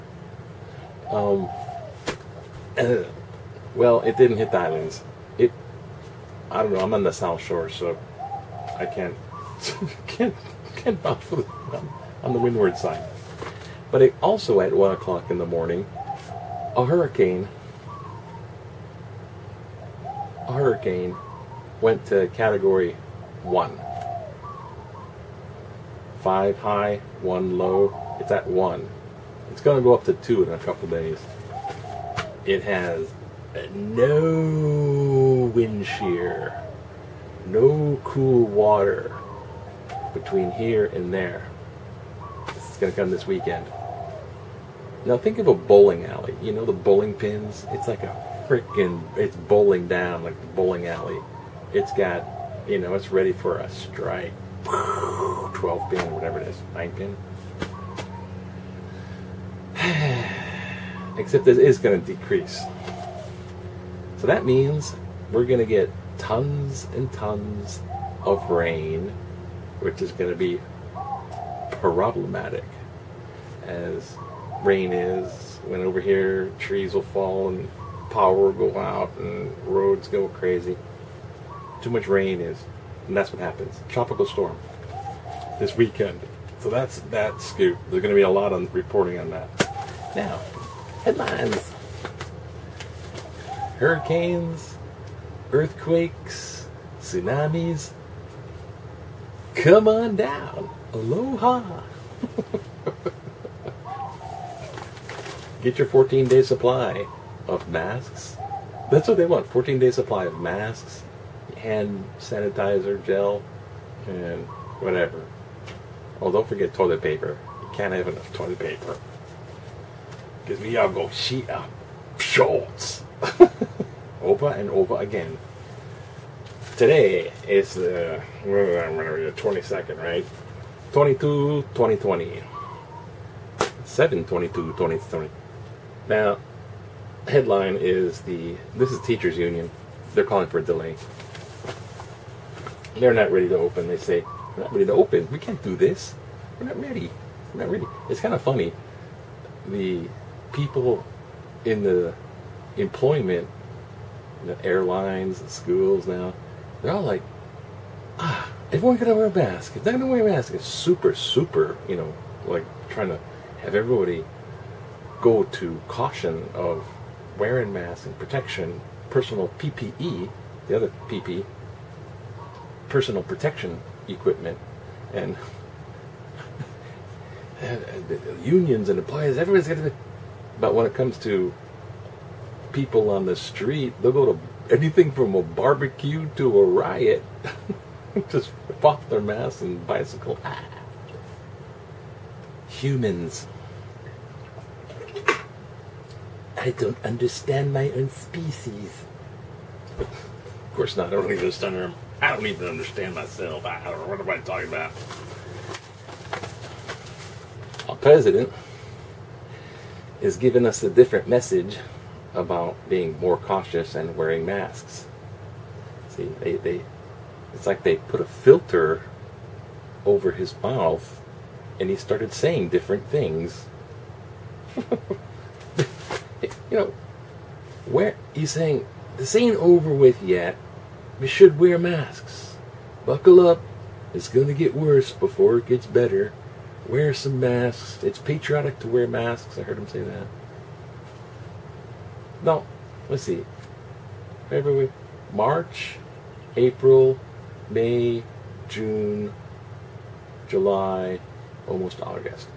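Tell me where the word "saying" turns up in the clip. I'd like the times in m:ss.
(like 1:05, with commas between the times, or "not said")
3:42, 3:48.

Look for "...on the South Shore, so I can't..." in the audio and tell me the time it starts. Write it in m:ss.
0:06.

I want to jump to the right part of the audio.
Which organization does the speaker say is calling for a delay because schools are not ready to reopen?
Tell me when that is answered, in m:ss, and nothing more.
2:19.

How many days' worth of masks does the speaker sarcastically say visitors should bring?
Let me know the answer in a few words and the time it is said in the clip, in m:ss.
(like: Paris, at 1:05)
14-day supply, at 1:45.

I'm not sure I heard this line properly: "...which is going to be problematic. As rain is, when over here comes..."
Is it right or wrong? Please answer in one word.
wrong.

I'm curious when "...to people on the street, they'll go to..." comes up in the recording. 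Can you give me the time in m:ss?
3:01.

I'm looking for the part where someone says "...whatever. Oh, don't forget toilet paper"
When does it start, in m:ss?
1:54.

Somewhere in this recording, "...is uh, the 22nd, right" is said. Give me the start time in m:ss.
2:07.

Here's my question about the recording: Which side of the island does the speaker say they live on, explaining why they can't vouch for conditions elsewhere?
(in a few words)
windward side.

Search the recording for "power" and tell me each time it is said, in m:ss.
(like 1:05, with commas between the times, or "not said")
1:18.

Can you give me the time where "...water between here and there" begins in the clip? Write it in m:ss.
0:38.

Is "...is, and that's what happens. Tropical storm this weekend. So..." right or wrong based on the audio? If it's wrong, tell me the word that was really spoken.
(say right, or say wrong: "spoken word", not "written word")
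right.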